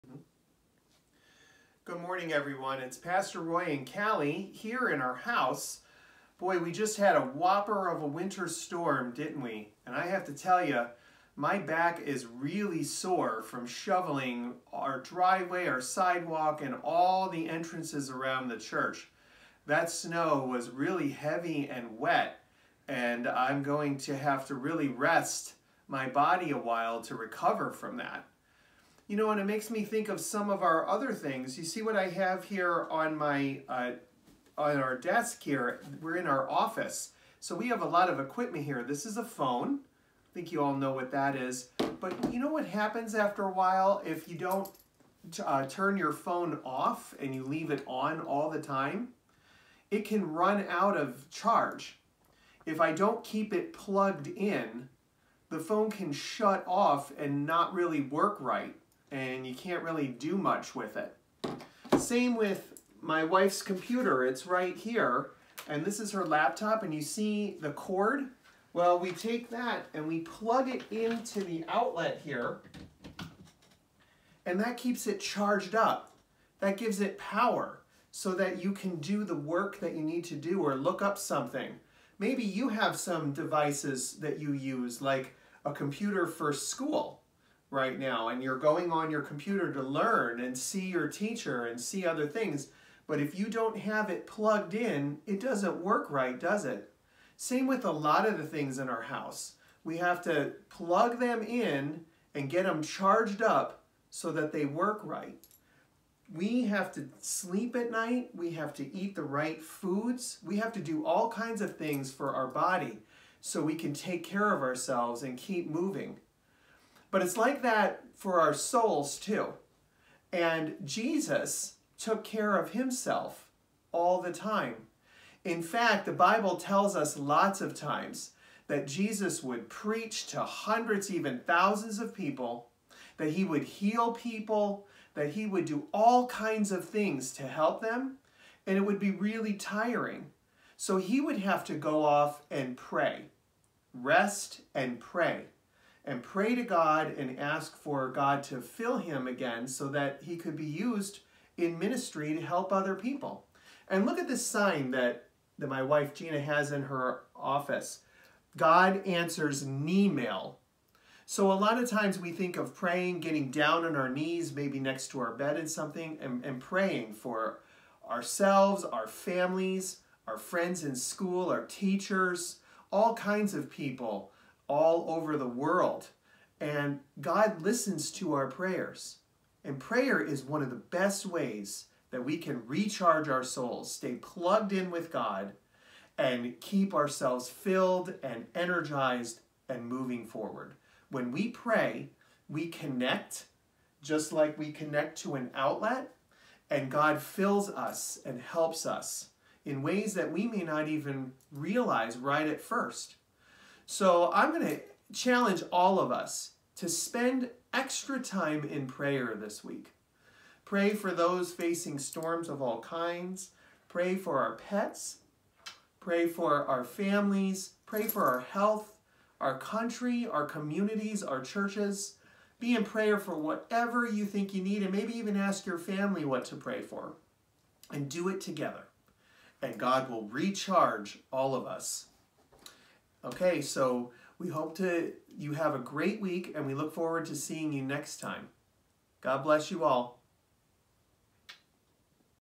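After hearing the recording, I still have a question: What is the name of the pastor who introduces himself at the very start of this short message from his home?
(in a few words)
Roy.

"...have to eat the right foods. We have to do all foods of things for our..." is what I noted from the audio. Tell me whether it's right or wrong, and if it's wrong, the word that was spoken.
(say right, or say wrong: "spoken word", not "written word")
wrong: "kinds", not "foods".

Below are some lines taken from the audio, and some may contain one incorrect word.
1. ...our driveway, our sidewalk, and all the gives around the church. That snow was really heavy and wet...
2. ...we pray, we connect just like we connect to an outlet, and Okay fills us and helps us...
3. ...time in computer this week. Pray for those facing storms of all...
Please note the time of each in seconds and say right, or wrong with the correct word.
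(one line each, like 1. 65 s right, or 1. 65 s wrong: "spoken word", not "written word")
1. 14 s wrong: "entrances", not "gives"
2. 191 s wrong: "God", not "Okay"
3. 208 s wrong: "prayer", not "computer".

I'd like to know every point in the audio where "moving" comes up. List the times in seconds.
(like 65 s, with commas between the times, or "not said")
115 s, 189 s.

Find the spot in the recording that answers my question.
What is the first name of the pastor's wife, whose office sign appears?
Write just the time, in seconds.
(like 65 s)
156 s.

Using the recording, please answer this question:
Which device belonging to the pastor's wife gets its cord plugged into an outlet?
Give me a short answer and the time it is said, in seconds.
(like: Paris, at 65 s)
Laptop, at 66 s.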